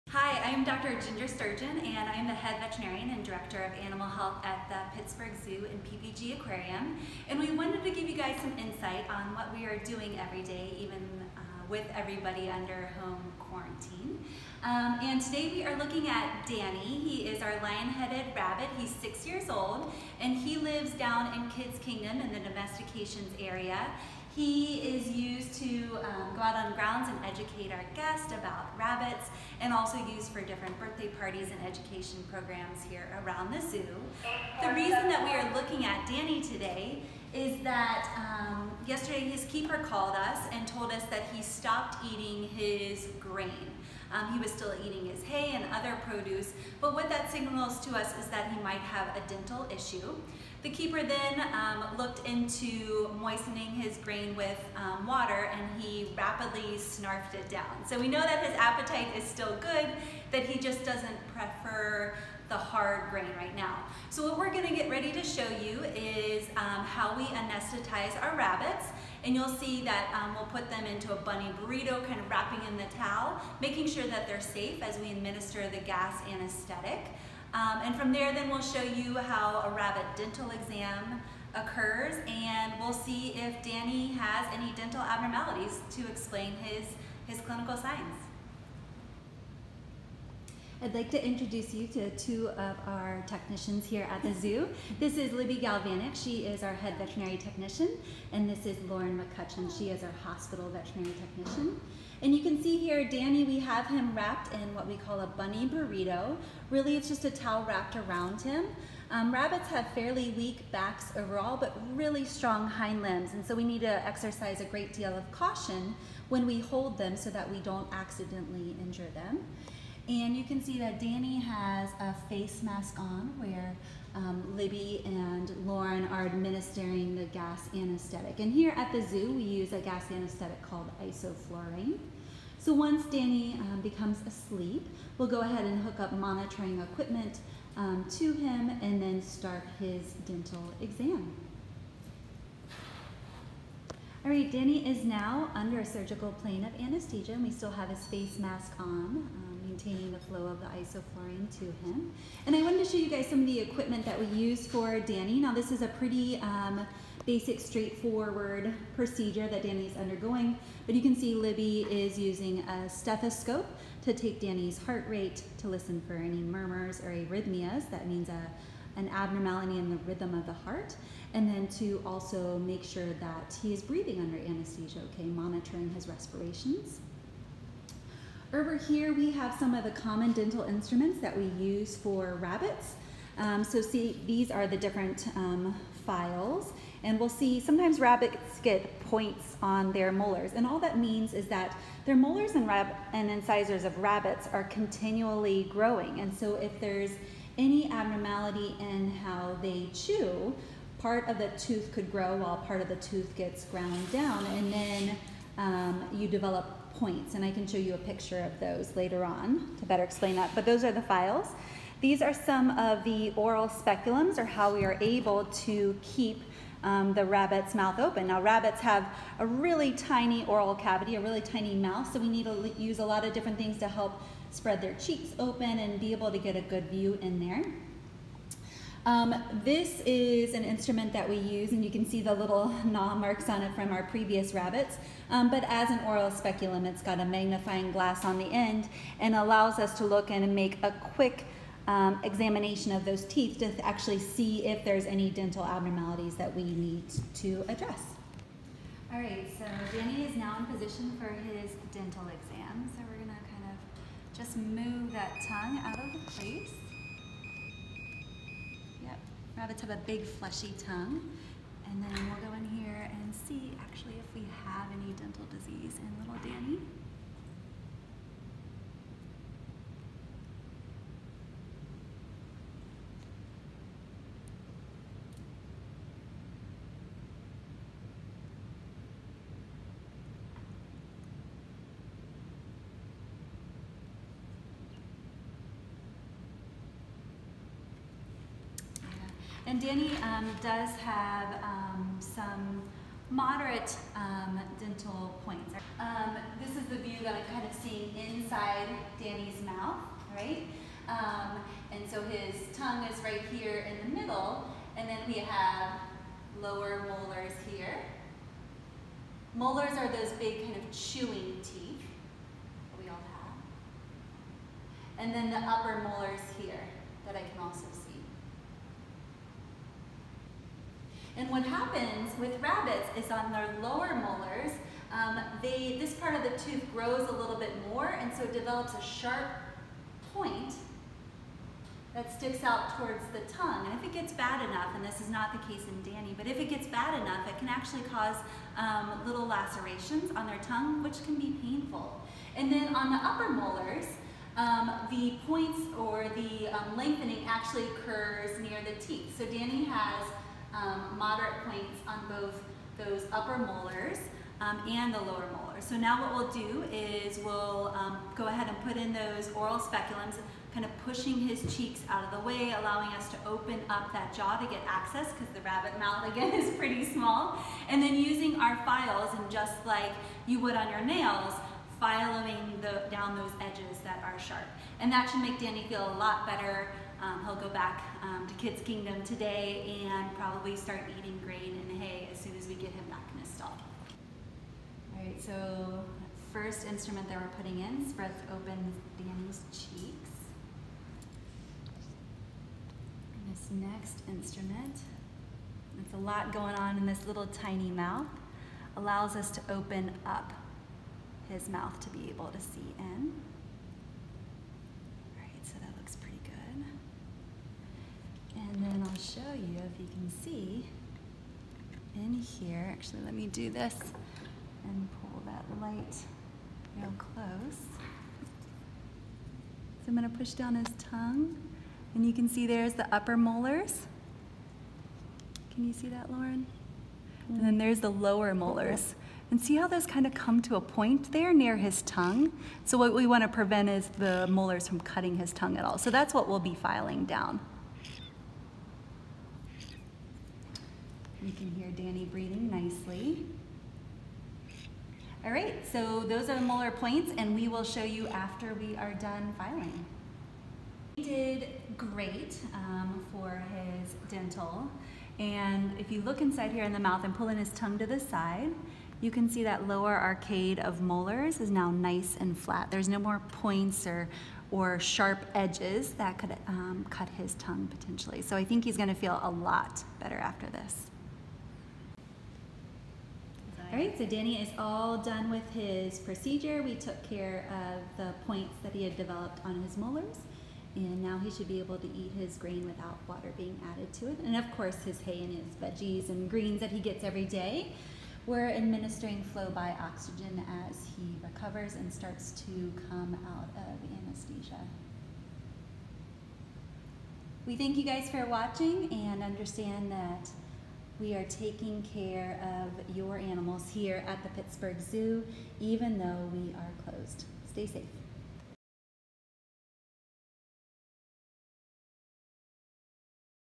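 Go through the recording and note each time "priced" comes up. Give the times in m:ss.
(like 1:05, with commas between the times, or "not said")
not said.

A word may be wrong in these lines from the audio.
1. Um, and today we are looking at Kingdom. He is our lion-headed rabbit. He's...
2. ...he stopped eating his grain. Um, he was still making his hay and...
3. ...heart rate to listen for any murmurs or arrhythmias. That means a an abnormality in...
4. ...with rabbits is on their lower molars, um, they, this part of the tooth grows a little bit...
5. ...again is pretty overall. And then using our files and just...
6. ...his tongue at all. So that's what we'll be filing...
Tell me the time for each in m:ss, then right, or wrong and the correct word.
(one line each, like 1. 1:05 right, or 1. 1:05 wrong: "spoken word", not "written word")
1. 0:14 wrong: "Danny", not "Kingdom"
2. 0:41 wrong: "eating", not "making"
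3. 2:44 right
4. 5:22 right
5. 6:06 wrong: "small", not "overall"
6. 7:15 right.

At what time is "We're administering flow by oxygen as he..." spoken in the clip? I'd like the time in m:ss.
8:08.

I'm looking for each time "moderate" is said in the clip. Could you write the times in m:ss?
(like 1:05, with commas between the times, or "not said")
4:53, 5:51.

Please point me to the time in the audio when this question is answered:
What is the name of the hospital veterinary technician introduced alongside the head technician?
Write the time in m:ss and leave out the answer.
1:38.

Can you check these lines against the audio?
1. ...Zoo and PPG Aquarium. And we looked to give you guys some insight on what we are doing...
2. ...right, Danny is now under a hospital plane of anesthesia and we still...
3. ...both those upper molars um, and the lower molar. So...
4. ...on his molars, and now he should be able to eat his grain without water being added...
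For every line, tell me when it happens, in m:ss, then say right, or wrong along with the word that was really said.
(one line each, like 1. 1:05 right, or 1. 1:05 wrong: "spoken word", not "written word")
1. 0:05 wrong: "wanted", not "looked"
2. 2:24 wrong: "surgical", not "hospital"
3. 5:52 right
4. 7:59 right.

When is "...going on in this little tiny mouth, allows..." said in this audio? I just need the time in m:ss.
6:36.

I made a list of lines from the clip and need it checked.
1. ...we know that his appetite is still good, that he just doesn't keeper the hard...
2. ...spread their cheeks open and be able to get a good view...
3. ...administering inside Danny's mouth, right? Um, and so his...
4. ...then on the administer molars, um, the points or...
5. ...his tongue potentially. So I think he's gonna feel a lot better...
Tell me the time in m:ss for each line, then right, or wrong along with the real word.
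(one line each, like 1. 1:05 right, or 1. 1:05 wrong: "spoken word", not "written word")
1. 0:57 wrong: "prefer", not "keeper"
2. 3:44 right
3. 4:57 wrong: "seeing", not "administering"
4. 5:42 wrong: "upper", not "administer"
5. 7:47 right.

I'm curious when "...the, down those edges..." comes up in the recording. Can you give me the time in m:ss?
6:12.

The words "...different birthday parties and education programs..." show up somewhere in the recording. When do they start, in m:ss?
0:30.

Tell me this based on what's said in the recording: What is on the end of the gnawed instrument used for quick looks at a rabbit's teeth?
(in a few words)
Magnifying glass.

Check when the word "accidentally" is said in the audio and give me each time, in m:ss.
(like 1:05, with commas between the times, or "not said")
1:57.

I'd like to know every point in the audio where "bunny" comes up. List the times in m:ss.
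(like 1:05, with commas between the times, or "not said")
1:11, 1:45.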